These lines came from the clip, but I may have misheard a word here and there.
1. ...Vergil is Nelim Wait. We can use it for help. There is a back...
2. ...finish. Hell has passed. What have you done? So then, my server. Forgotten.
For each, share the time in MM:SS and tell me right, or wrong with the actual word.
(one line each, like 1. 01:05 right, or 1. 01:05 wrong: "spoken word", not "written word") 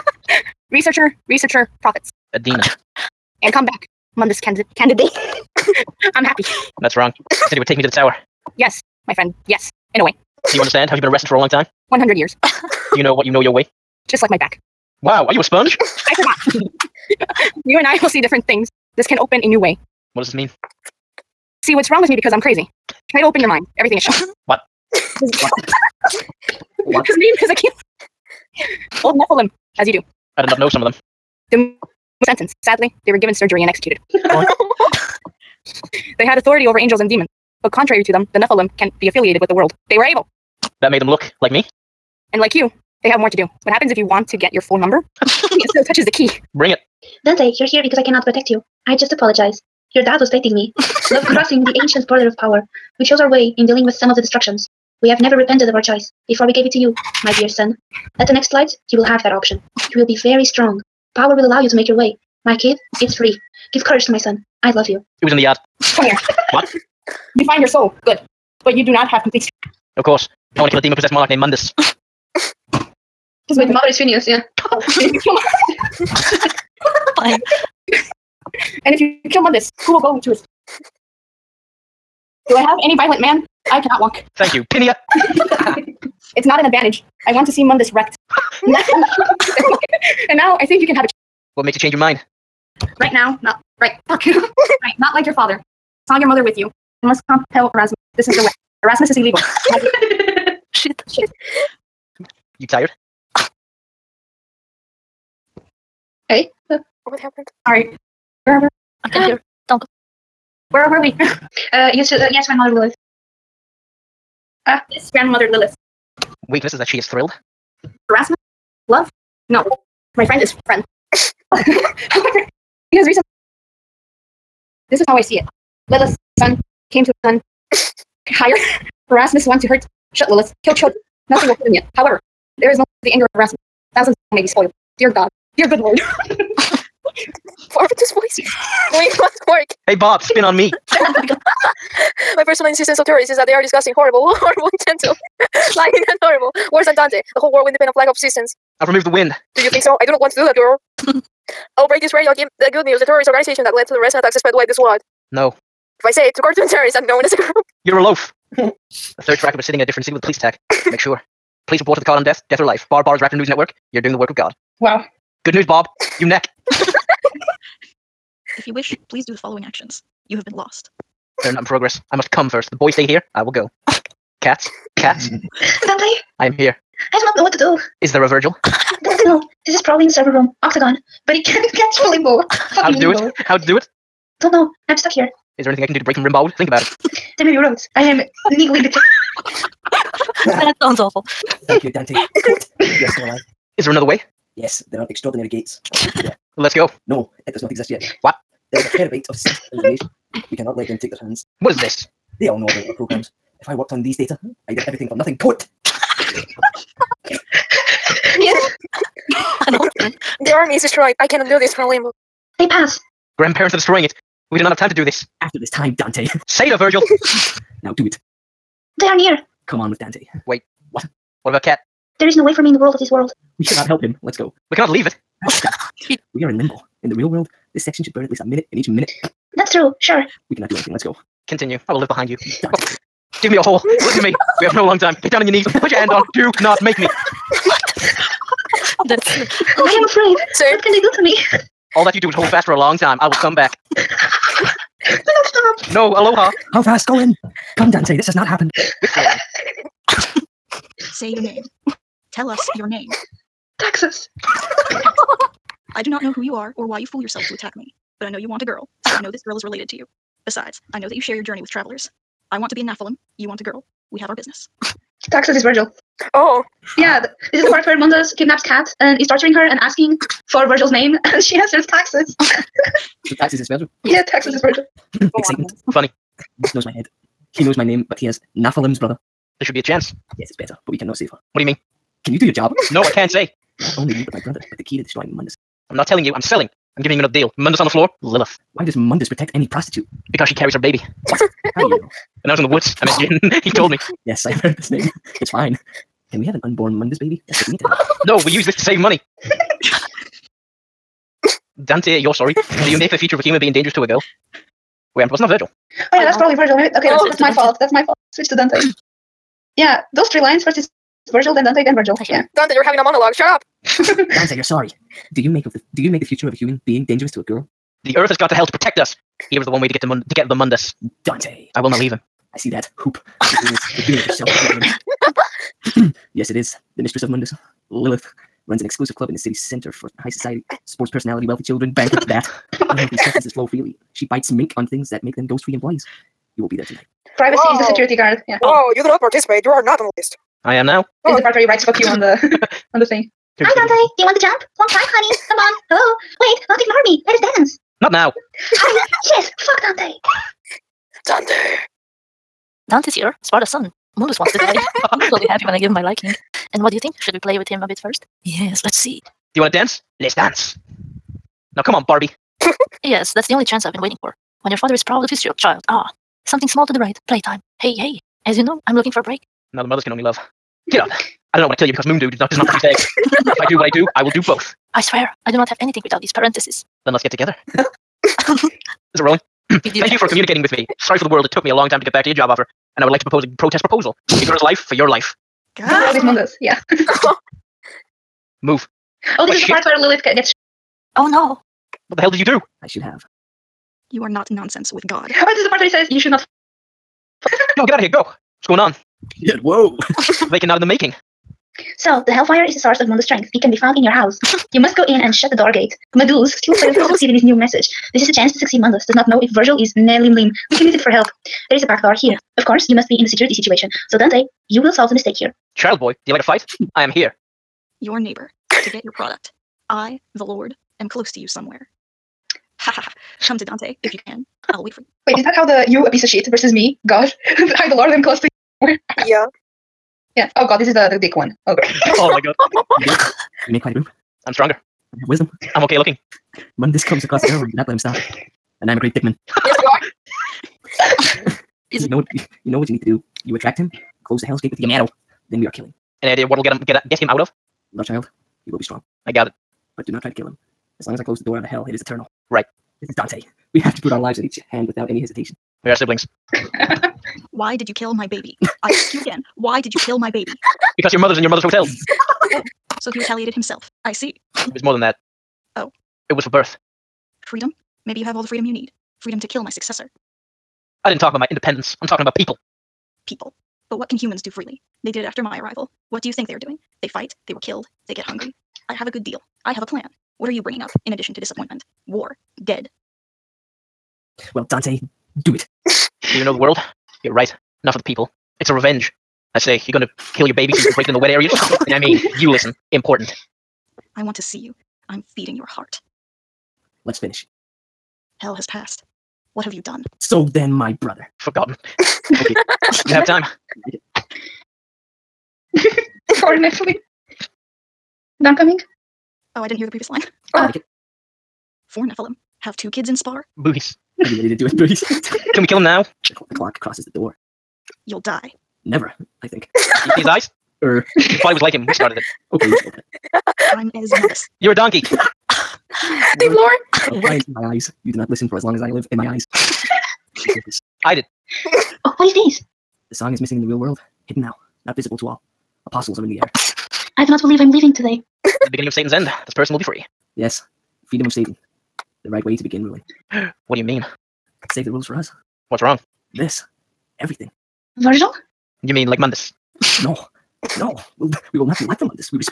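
1. 06:49 wrong: "Lim", not "Wait"
2. 08:17 wrong: "brother", not "server".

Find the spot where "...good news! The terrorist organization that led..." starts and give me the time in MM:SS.
02:32.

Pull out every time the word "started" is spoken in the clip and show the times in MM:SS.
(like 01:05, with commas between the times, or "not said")
08:41.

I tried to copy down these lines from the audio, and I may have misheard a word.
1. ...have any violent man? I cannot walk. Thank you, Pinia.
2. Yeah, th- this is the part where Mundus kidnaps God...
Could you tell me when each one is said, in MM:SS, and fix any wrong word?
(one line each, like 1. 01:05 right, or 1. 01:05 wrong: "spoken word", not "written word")
1. 01:22 right
2. 04:26 wrong: "Kat", not "God".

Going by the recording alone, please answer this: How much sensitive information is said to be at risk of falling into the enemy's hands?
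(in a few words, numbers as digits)
A terabyte.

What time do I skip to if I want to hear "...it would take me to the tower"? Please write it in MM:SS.
00:07.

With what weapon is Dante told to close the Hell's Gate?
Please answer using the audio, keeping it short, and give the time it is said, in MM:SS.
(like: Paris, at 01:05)
Yamato, at 07:24.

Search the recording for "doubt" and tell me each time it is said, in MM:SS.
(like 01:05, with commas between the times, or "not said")
not said.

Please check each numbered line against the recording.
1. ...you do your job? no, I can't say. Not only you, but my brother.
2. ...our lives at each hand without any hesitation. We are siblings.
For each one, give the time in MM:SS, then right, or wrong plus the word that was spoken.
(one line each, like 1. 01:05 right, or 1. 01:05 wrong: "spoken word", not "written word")
1. 04:42 right
2. 07:34 right.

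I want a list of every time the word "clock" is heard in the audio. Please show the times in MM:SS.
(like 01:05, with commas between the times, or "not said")
08:36.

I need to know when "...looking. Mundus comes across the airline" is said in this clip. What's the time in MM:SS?
07:15.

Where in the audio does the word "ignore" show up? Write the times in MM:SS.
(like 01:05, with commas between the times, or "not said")
05:46.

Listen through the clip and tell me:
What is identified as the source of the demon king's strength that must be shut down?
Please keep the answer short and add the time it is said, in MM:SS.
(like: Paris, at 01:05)
Hellfire, at 06:42.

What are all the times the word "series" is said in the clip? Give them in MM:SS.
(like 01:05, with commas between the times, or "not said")
not said.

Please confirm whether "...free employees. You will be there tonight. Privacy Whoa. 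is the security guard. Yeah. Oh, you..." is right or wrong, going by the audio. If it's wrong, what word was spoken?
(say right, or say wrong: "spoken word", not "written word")
right.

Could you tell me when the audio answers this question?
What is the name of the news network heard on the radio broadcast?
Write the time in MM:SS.
02:43.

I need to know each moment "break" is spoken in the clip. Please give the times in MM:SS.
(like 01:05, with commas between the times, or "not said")
02:31, 03:06, 06:09, 08:10.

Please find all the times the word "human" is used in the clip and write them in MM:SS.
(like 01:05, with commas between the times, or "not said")
05:03, 05:16, 07:54.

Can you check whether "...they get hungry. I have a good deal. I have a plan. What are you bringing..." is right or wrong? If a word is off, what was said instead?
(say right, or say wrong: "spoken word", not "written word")
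right.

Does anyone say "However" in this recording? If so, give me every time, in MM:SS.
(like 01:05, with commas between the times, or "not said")
02:01, 02:11.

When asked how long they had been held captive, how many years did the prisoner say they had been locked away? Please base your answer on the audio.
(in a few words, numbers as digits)
100 years.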